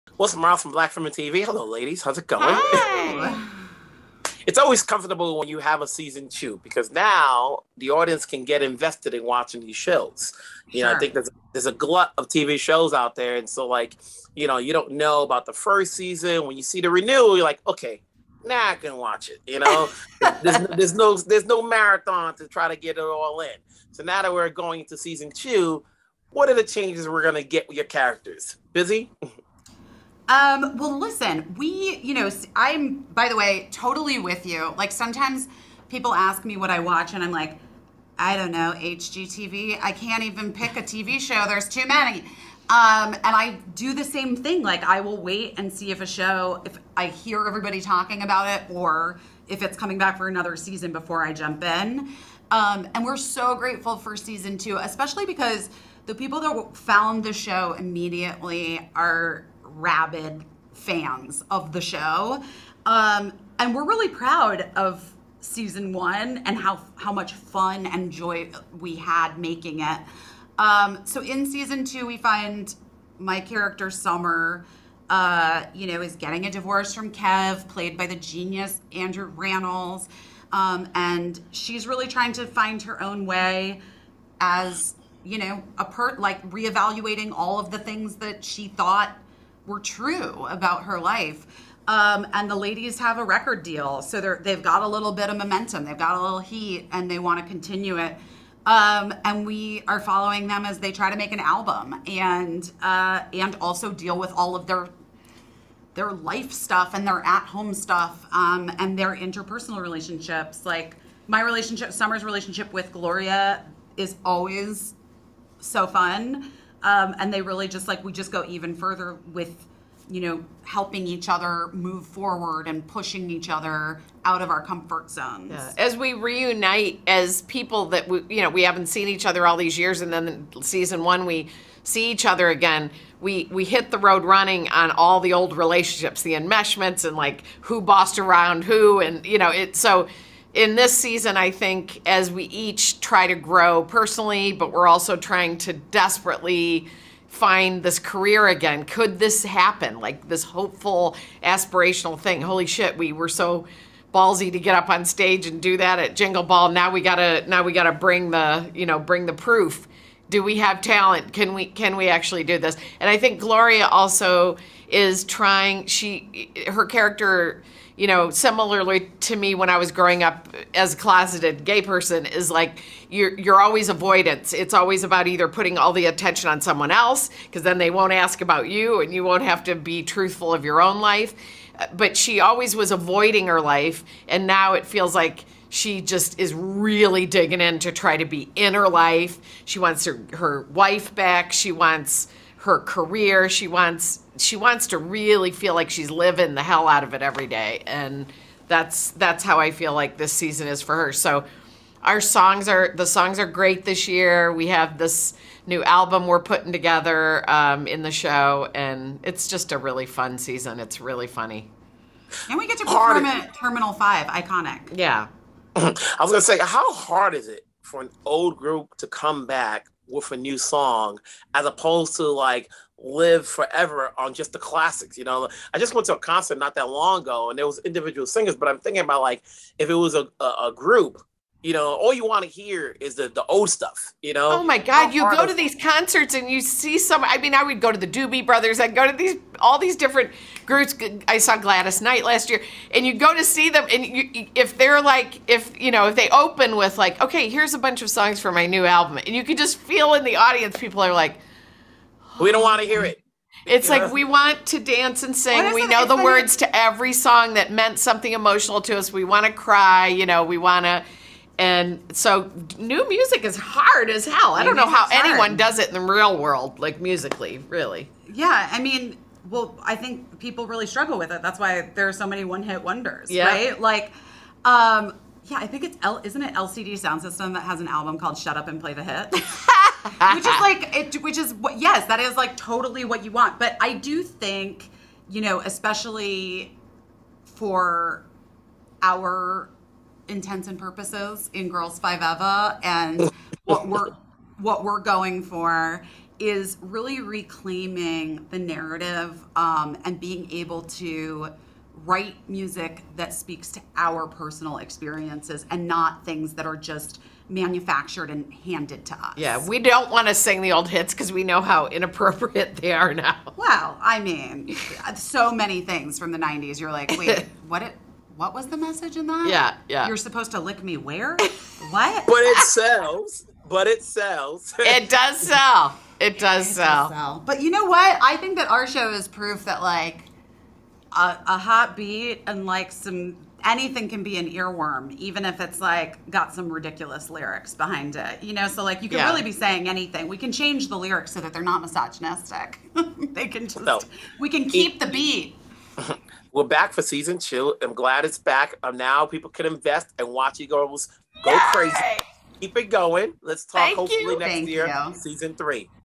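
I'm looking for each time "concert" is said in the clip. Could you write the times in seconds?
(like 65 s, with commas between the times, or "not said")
226 s, 235 s.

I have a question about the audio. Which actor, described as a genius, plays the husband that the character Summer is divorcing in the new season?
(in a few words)
Andrew Rannells.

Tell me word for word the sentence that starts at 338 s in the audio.
You know, so like you can yeah.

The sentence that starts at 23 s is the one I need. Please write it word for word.
So now that we're going into season two, what are the changes we're gonna get with your characters?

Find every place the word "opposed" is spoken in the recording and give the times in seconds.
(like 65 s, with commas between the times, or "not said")
221 s.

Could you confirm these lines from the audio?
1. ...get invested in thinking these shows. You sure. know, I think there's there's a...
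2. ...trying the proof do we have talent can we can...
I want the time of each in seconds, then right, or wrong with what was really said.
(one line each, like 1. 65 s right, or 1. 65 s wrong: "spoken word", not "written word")
1. 8 s wrong: "watching", not "thinking"
2. 158 s wrong: "bring", not "trying".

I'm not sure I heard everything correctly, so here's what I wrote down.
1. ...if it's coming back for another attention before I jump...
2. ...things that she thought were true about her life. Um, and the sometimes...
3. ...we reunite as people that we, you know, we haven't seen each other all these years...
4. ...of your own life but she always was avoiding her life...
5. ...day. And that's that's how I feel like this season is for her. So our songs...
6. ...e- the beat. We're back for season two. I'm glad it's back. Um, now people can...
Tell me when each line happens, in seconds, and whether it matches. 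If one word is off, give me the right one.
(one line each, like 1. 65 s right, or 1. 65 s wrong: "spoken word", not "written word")
1. 49 s wrong: "season", not "attention"
2. 87 s wrong: "ladies", not "sometimes"
3. 125 s right
4. 180 s right
5. 197 s right
6. 344 s right.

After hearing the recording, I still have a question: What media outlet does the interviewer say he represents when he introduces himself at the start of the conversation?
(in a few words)
Black Film and TV.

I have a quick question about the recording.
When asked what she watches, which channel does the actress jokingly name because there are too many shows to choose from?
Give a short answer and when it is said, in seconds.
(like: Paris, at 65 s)
HGTV, at 38 s.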